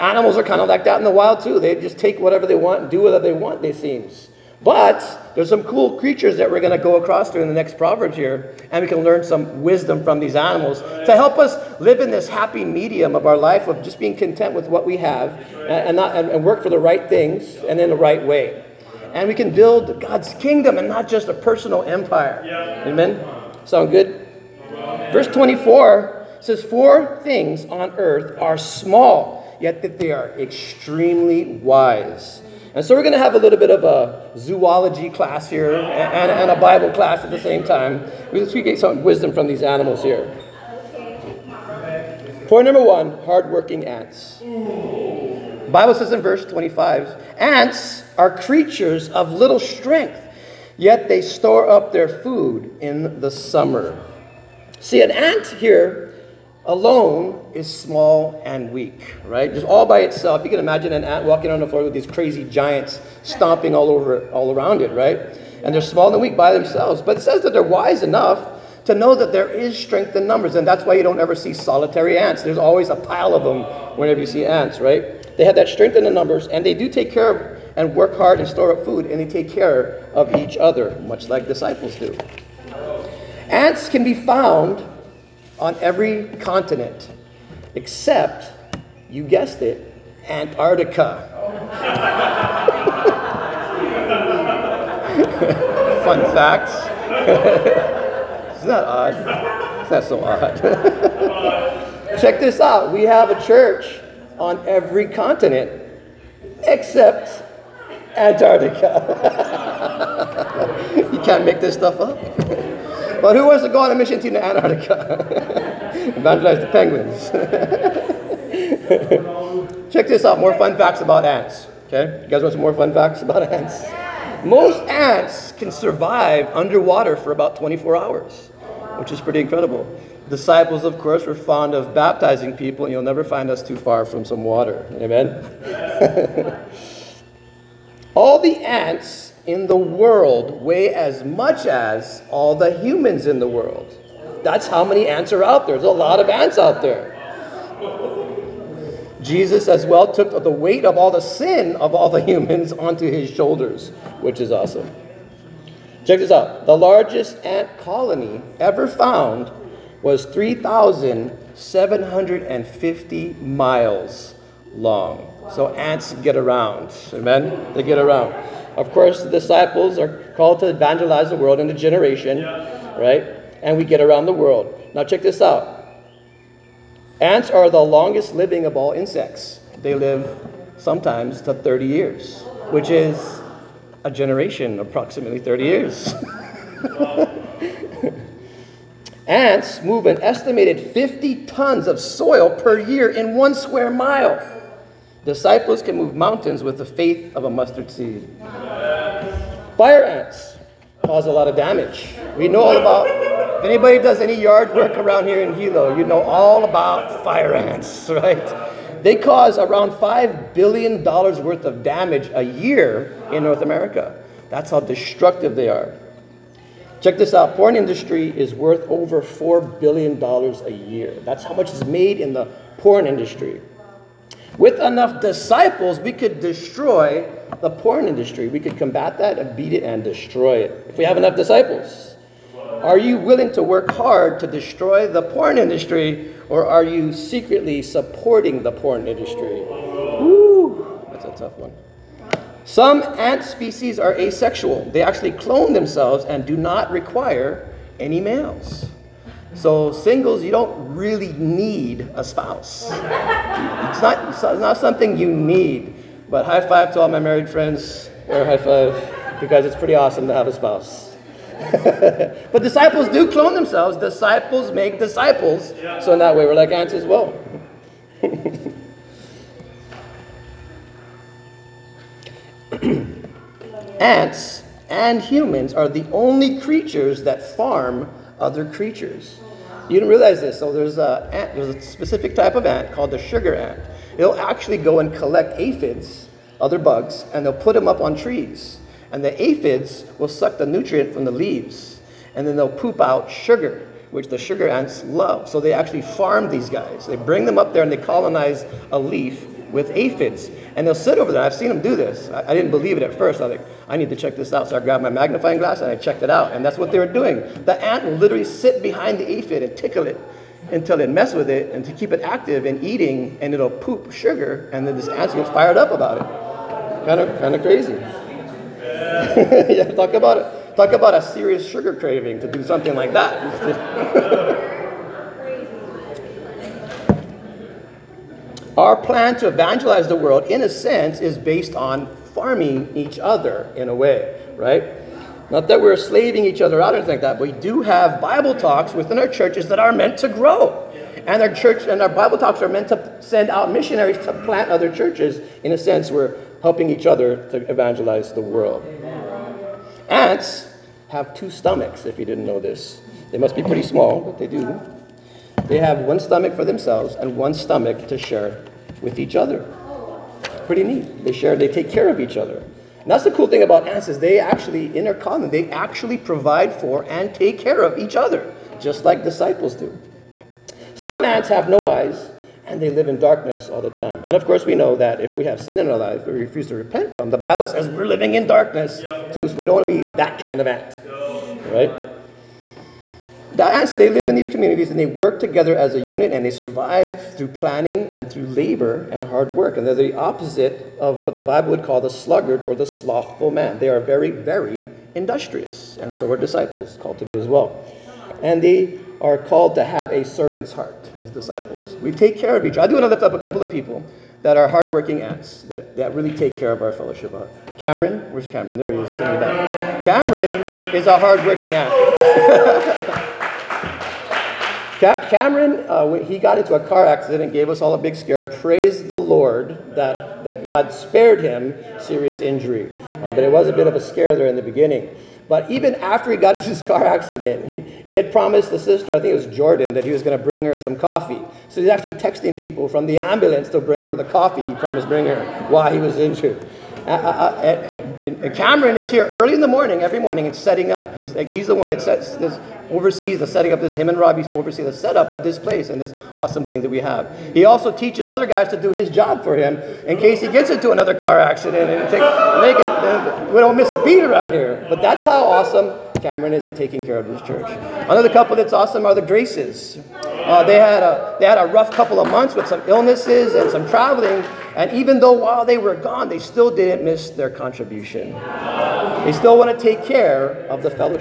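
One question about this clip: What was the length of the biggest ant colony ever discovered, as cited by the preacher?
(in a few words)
3,750 miles.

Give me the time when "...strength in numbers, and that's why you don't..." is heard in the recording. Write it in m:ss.
1:09.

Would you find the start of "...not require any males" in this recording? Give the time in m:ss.
4:06.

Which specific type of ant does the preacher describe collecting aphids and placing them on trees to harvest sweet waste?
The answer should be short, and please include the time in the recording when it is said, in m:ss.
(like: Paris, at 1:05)
sugar ant, at 4:43.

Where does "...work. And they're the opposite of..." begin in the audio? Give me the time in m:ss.
6:29.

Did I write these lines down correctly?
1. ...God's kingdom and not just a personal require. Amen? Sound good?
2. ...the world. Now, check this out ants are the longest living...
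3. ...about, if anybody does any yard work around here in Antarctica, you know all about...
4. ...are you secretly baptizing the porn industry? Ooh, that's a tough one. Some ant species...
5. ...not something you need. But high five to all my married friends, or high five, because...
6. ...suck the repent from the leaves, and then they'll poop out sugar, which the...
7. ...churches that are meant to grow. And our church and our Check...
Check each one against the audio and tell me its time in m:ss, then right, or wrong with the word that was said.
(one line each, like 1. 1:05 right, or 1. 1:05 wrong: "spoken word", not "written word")
1. 0:20 wrong: "empire", not "require"
2. 2:54 right
3. 3:22 wrong: "Hilo", not "Antarctica"
4. 3:56 wrong: "supporting", not "baptizing"
5. 4:14 right
6. 4:50 wrong: "nutrient", not "repent"
7. 5:39 wrong: "Bible", not "Check".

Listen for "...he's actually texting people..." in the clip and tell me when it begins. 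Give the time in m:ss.
7:11.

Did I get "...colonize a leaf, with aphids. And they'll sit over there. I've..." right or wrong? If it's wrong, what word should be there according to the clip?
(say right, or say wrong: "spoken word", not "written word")
right.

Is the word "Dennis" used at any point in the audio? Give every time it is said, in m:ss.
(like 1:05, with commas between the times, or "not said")
not said.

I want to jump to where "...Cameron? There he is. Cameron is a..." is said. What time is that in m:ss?
6:48.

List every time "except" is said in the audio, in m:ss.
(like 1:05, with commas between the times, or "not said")
1:27, 1:46.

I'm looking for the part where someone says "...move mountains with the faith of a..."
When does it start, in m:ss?
3:15.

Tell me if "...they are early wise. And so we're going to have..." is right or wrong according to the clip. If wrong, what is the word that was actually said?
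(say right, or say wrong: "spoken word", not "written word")
wrong: "extremely", not "early".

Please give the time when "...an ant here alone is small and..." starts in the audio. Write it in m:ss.
0:55.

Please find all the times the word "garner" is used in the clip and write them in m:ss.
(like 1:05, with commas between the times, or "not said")
not said.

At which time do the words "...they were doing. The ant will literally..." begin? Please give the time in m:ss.
5:06.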